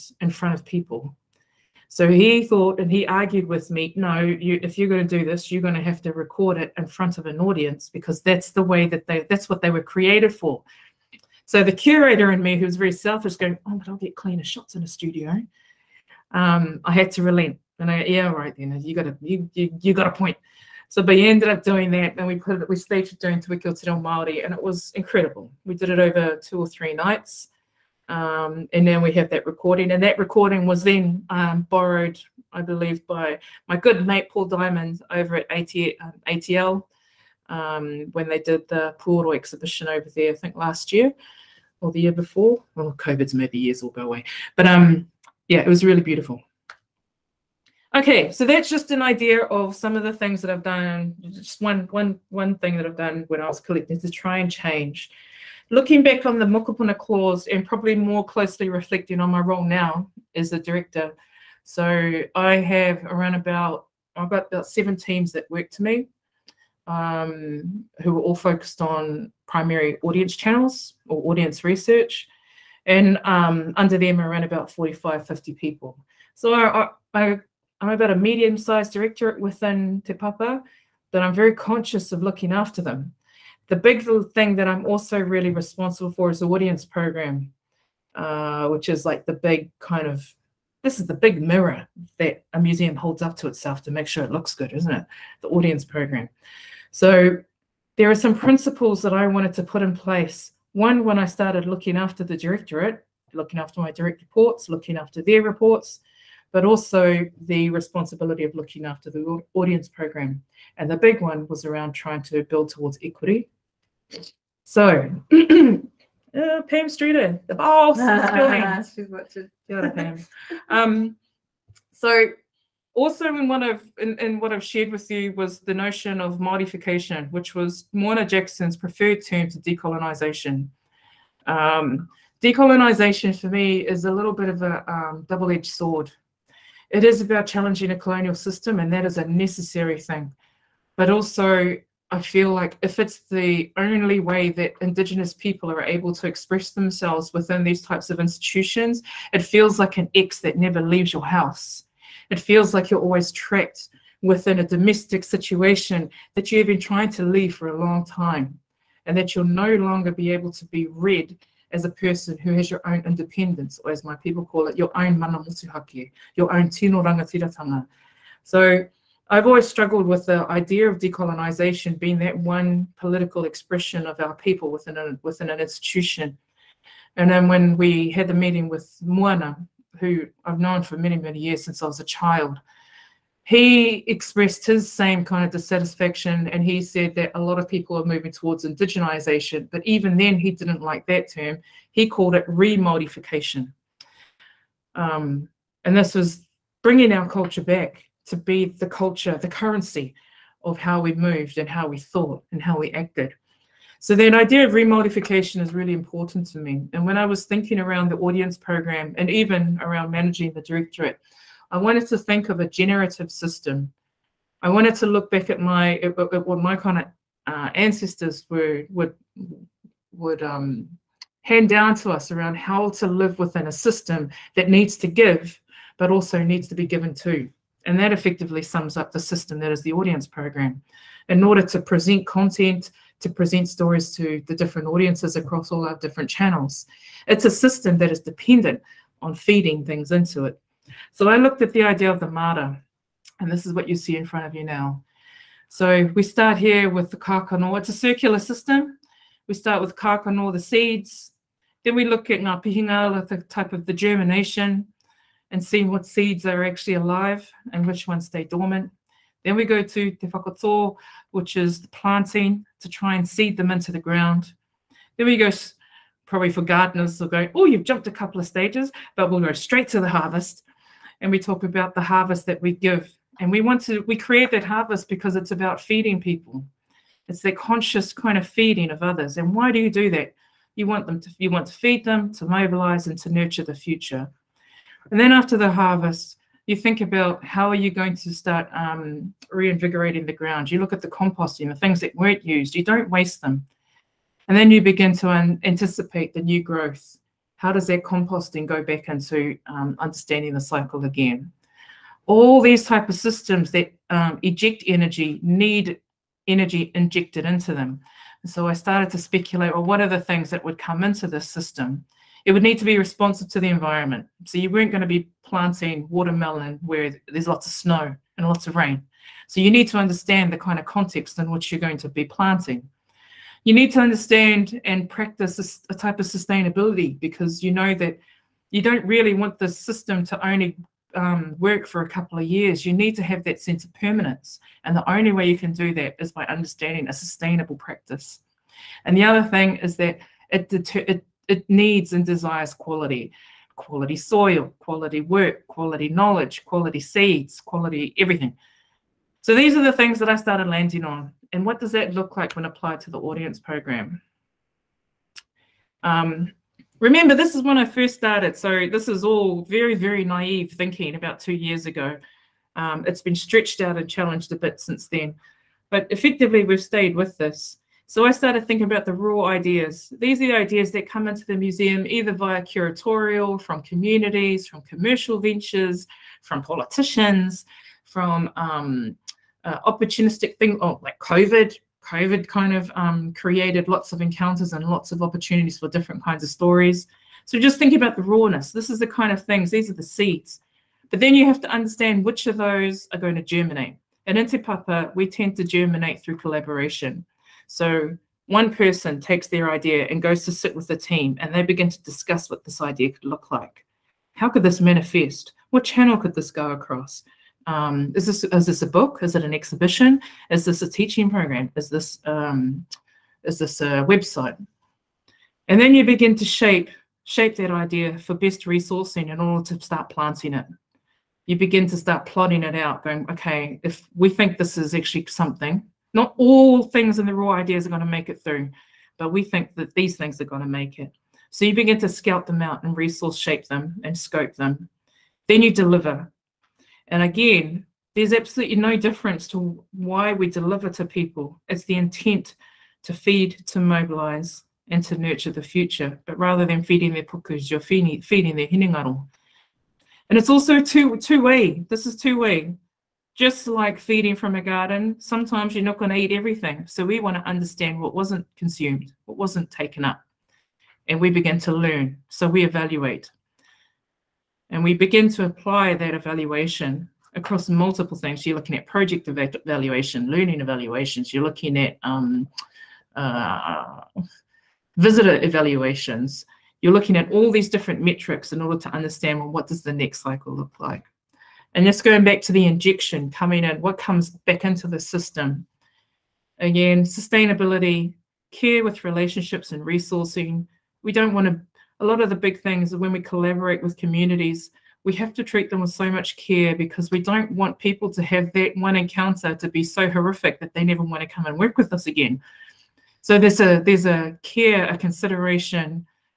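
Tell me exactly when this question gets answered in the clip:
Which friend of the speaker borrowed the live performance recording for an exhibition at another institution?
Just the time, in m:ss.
0:34.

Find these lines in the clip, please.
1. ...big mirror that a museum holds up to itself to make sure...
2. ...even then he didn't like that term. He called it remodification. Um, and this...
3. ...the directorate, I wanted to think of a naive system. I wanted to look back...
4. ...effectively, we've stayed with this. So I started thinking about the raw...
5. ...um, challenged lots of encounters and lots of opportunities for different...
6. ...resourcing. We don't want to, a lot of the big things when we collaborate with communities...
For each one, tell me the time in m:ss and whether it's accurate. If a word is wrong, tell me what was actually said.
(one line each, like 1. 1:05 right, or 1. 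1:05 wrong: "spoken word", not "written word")
1. 1:31 right
2. 3:09 right
3. 3:30 wrong: "generative", not "naive"
4. 6:06 right
5. 6:22 wrong: "created", not "challenged"
6. 8:09 right.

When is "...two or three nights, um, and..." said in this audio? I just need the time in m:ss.
0:26.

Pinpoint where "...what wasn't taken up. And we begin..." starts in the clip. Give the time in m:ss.
7:39.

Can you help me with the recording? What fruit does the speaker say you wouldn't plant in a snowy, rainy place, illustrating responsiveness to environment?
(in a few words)
watermelon.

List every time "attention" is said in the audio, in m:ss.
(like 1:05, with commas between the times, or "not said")
not said.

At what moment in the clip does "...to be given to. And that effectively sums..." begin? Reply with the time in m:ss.
3:46.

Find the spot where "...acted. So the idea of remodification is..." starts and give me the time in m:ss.
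3:22.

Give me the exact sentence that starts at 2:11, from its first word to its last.
Um, decolonization for me is a little bit of a um, double-edged sword.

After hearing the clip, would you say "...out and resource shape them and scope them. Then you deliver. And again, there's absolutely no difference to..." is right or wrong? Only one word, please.
right.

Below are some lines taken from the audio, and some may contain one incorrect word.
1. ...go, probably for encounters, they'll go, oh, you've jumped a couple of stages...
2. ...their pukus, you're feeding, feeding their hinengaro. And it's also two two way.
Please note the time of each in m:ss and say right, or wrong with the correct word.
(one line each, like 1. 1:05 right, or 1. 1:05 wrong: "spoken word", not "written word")
1. 4:25 wrong: "gardeners", not "encounters"
2. 7:27 right.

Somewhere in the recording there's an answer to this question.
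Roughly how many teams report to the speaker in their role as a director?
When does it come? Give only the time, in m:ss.
1:04.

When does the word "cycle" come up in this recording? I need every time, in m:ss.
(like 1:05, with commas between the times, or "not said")
5:00, 8:00.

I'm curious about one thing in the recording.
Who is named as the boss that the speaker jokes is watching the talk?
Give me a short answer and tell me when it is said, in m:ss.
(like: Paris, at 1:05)
Pam Streeter, at 1:56.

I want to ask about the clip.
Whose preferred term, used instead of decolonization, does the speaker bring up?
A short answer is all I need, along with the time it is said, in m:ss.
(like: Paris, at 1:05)
Moana Jackson, at 2:07.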